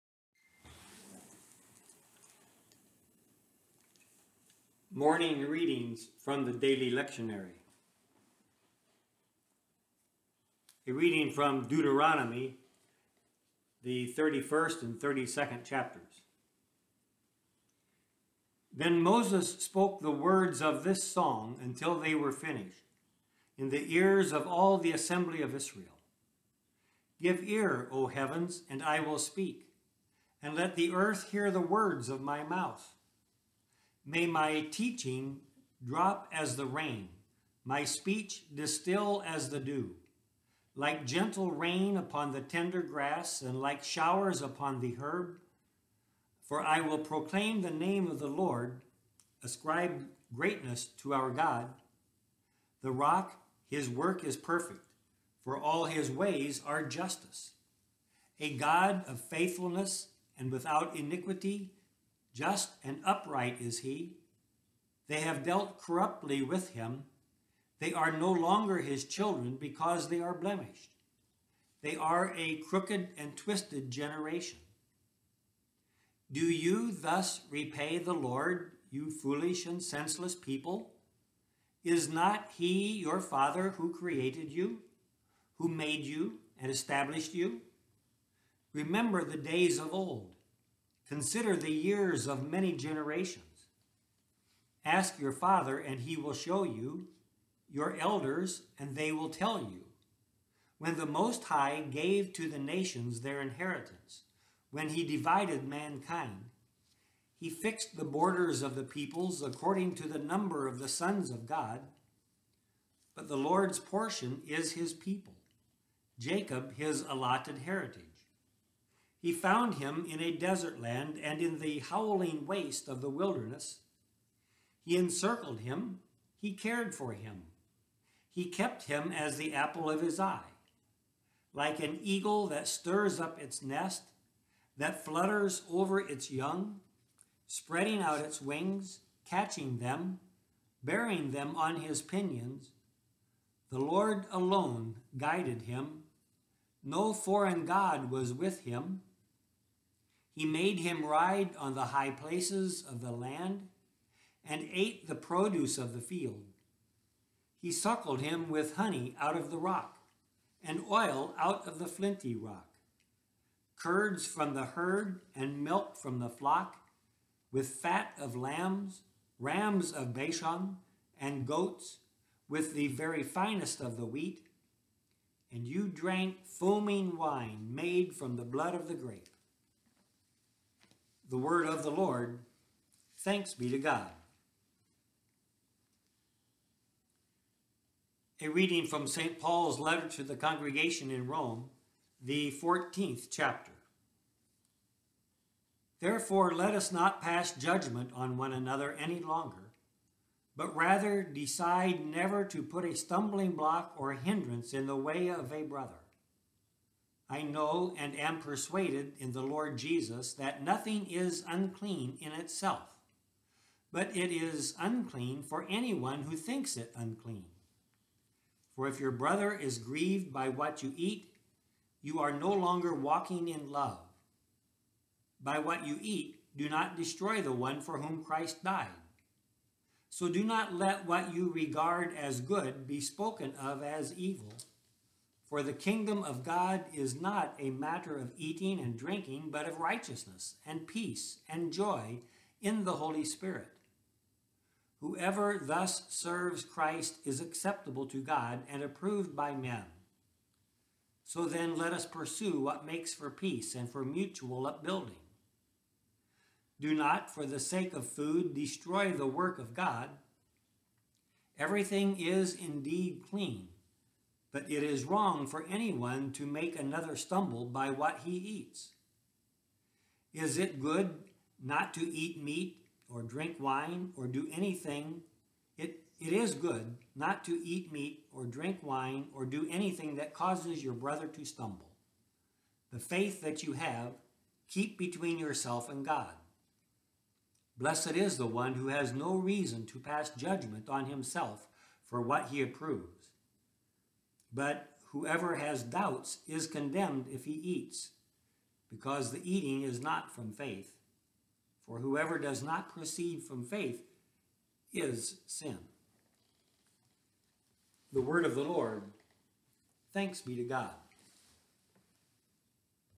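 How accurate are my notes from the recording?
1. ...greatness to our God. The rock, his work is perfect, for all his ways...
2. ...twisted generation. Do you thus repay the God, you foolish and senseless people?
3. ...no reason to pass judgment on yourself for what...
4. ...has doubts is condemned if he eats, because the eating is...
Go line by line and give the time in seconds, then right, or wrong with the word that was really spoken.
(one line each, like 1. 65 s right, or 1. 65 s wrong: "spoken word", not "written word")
1. 50 s right
2. 73 s wrong: "Lord", not "God"
3. 289 s wrong: "himself", not "yourself"
4. 295 s right.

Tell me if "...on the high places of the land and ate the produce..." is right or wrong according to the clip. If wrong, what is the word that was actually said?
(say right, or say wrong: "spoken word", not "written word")
right.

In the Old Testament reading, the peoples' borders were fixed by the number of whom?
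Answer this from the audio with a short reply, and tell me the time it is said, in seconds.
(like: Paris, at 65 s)
Sons of God, at 110 s.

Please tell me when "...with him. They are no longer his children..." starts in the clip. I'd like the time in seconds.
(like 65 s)
66 s.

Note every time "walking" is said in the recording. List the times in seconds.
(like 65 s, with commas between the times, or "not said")
222 s.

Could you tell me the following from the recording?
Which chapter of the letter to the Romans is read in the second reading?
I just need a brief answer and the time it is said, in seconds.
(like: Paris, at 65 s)
14, at 192 s.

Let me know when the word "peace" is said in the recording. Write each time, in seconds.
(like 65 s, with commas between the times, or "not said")
240 s, 253 s.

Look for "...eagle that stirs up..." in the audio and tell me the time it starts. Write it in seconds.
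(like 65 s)
132 s.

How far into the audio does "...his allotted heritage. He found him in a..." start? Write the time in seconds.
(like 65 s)
116 s.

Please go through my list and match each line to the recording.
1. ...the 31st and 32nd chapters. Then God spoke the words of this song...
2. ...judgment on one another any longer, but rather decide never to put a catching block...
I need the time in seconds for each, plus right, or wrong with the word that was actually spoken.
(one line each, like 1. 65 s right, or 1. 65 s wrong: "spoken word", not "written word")
1. 13 s wrong: "Moses", not "God"
2. 197 s wrong: "stumbling", not "catching".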